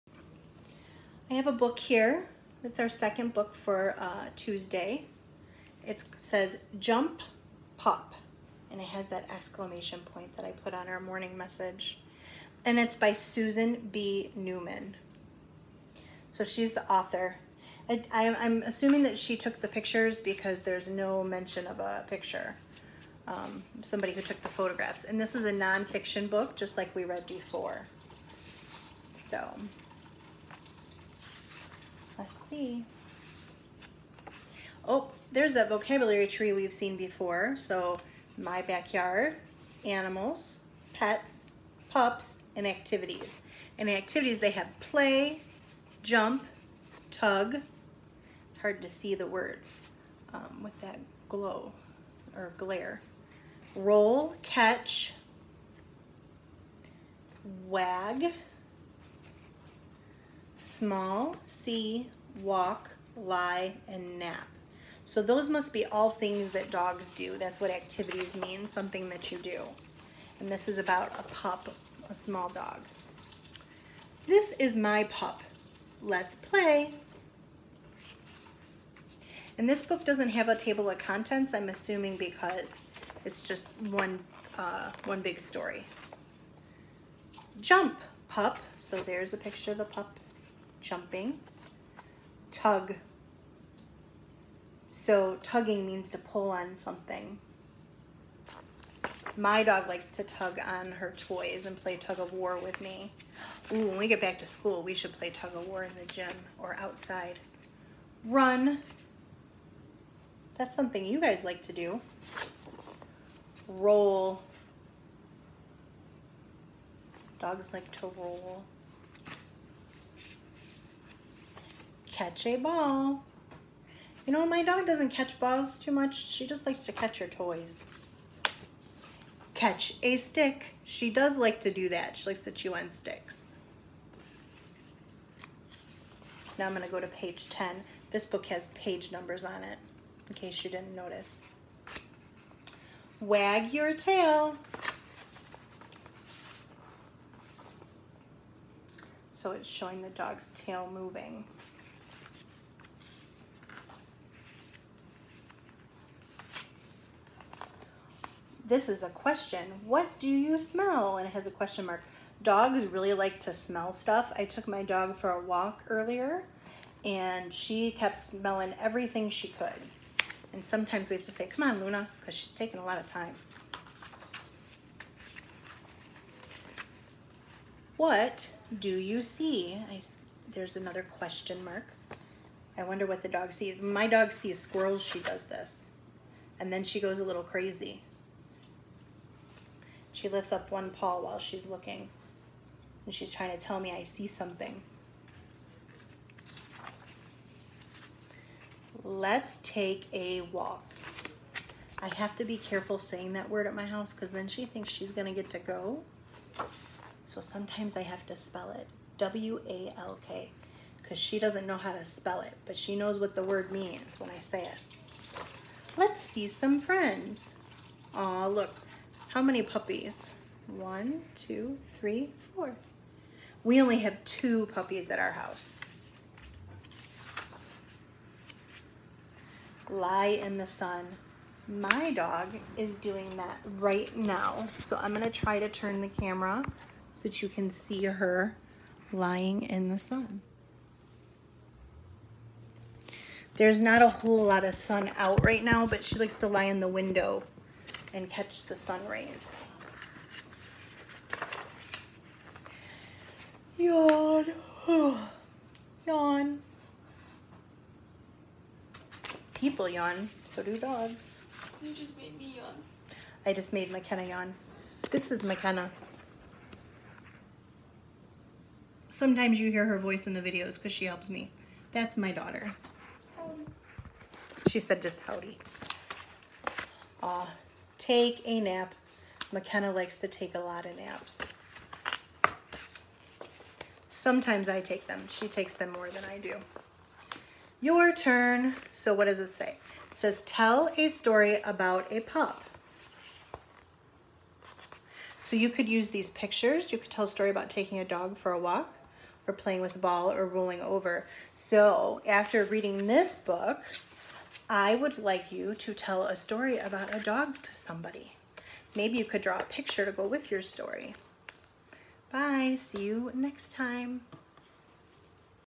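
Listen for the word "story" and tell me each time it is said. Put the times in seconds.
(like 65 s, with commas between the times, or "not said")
85 s, 291 s, 297 s, 306 s, 310 s.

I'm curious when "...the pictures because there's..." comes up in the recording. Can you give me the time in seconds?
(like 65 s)
19 s.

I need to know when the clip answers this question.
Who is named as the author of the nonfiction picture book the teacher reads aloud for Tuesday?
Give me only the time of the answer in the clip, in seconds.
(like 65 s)
13 s.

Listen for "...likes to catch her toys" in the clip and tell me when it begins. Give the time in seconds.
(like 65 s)
126 s.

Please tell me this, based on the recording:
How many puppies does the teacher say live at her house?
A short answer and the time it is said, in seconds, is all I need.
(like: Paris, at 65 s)
2, at 224 s.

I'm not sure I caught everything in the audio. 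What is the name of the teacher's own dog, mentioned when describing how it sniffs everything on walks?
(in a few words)
Luna.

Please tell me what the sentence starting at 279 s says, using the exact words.
McKenna likes to take a lot of naps.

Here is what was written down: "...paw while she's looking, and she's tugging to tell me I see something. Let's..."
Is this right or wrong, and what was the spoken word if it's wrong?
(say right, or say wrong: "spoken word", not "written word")
wrong: "trying", not "tugging".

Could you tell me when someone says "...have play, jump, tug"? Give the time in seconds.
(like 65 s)
44 s.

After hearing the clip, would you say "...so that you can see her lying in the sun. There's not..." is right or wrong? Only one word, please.
right.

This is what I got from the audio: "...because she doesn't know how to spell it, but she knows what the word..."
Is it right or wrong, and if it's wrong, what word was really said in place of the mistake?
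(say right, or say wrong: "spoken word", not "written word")
right.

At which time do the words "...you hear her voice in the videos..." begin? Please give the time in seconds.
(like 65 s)
269 s.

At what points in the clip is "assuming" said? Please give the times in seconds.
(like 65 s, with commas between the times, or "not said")
18 s, 81 s.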